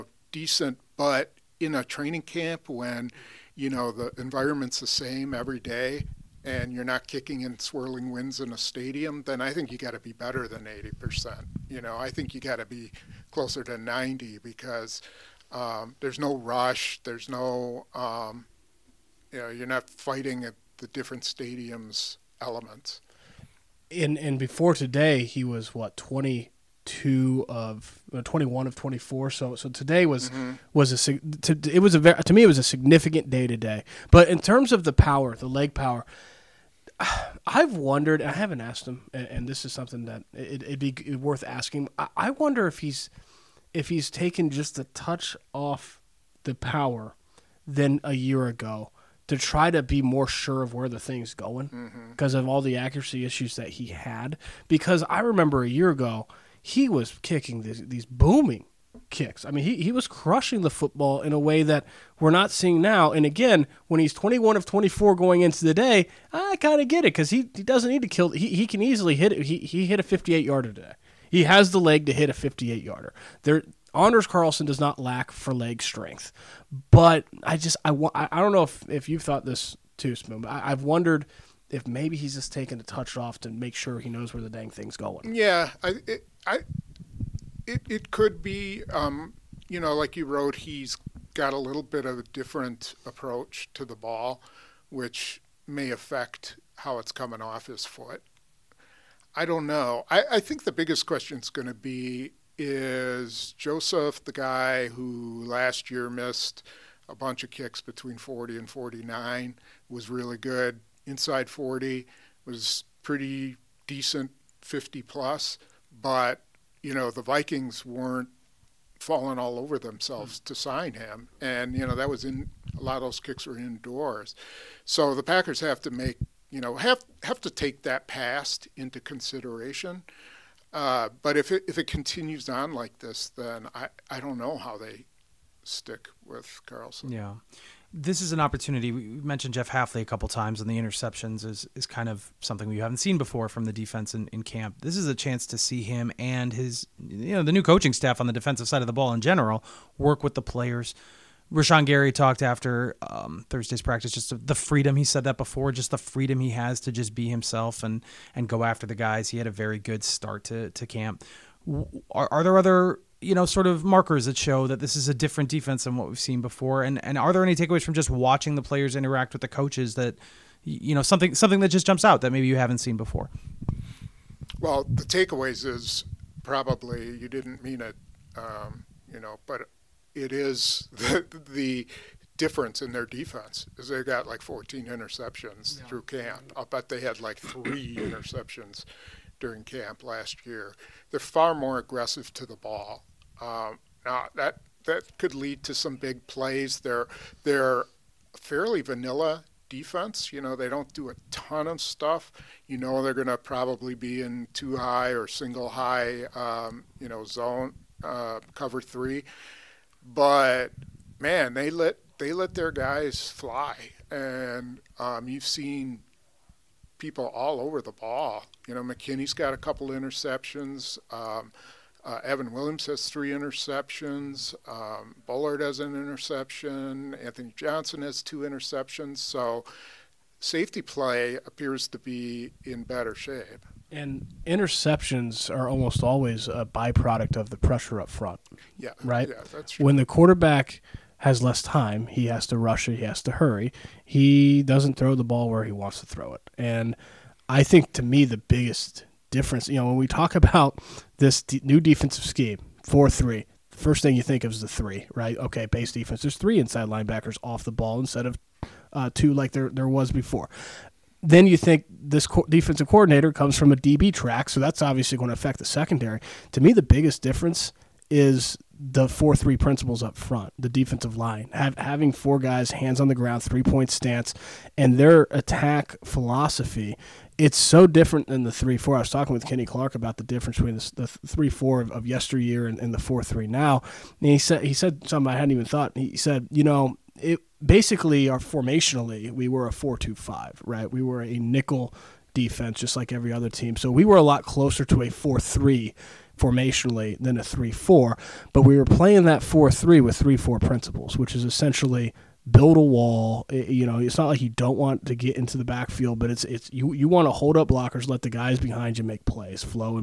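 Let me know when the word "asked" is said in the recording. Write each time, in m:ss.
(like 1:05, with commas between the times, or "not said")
0:38.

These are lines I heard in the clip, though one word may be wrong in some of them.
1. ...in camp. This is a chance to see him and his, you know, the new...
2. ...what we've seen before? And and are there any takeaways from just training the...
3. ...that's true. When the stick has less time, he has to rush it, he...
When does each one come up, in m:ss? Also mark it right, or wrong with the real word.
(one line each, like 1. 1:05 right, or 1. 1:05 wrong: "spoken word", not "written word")
1. 2:24 right
2. 2:45 wrong: "watching", not "training"
3. 3:59 wrong: "quarterback", not "stick".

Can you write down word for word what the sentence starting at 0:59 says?
I mean, he, he was crushing the football in a way that we're not seeing now.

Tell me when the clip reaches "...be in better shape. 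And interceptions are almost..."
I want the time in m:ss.
3:51.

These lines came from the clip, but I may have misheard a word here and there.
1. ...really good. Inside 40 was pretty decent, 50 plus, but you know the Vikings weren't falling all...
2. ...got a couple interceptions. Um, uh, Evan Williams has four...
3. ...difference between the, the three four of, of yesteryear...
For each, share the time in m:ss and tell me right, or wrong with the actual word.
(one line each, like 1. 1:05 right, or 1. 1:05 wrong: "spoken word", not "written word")
1. 1:50 right
2. 3:39 wrong: "three", not "four"
3. 4:40 right.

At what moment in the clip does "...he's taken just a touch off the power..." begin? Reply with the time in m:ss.
0:43.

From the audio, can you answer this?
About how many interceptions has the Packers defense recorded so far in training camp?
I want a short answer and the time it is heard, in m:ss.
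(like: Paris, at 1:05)
14, at 3:04.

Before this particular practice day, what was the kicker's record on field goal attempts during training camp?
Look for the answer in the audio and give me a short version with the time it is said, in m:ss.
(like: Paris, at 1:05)
21 of 24, at 0:28.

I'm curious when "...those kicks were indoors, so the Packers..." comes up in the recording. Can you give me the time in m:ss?
2:03.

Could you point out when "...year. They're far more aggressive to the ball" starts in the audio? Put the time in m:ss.
3:10.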